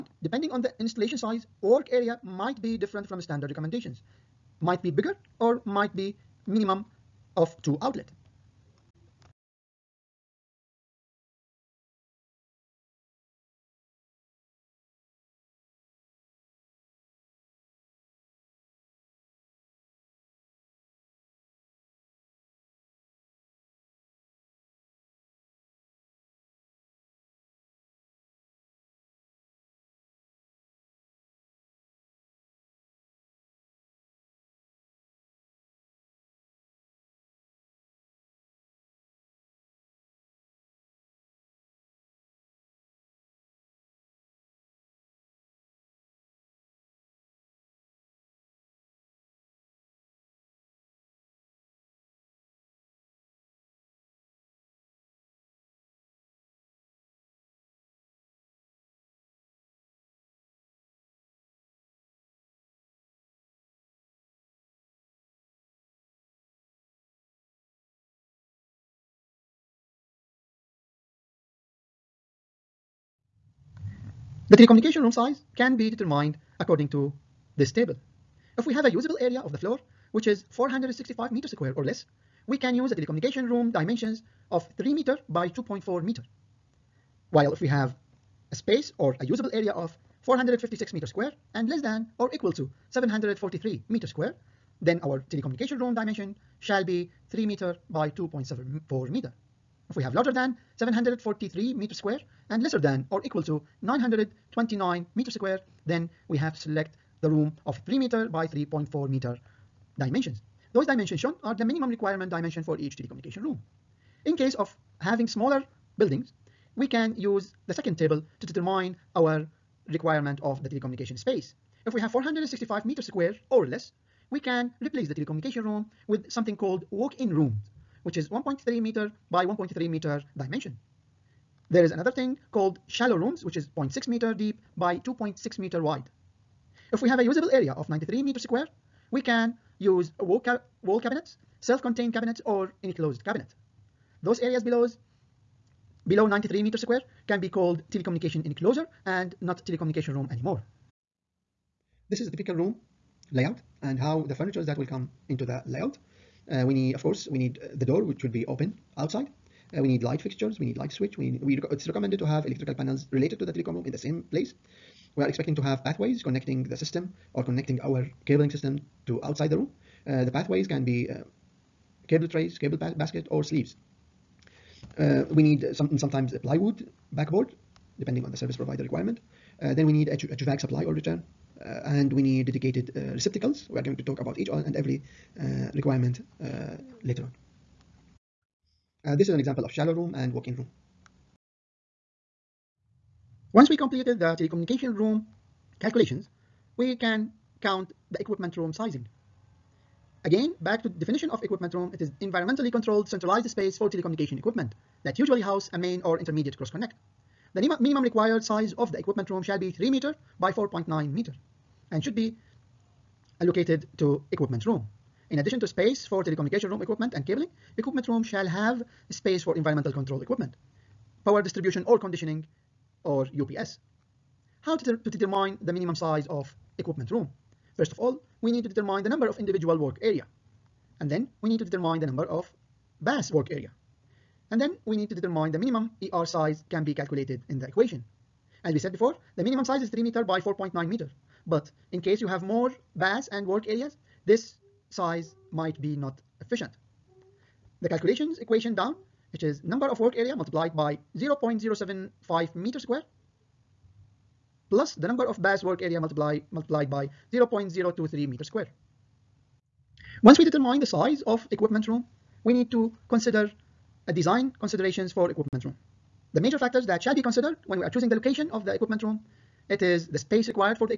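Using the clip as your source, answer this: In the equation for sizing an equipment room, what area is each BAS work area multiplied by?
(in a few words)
0.023 square meters.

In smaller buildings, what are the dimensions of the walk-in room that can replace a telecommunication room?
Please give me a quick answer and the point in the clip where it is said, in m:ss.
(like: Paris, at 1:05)
1.3 m by 1.3 m, at 2:08.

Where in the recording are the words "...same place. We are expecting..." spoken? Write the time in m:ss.
2:43.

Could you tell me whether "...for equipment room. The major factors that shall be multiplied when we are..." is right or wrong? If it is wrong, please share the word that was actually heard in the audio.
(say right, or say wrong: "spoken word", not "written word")
wrong: "considered", not "multiplied".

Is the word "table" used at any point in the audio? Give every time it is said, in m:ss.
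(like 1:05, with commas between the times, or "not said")
1:17, 1:57.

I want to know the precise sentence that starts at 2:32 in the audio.
This is a typical room layout and how the furnitures that will come into the layout.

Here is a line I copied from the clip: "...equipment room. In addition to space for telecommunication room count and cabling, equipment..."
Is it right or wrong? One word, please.
wrong.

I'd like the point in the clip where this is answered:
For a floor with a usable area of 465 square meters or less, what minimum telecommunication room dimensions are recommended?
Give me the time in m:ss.
1:24.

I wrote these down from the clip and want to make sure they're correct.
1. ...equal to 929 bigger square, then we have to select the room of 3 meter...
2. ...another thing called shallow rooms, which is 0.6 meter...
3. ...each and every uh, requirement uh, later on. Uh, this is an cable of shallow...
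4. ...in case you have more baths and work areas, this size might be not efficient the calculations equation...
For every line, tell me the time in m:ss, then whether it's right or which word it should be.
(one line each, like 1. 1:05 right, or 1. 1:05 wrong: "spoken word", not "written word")
1. 1:43 wrong: "meter", not "bigger"
2. 2:11 right
3. 3:04 wrong: "example", not "cable"
4. 4:01 right.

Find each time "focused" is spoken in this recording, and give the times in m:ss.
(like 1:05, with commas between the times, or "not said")
not said.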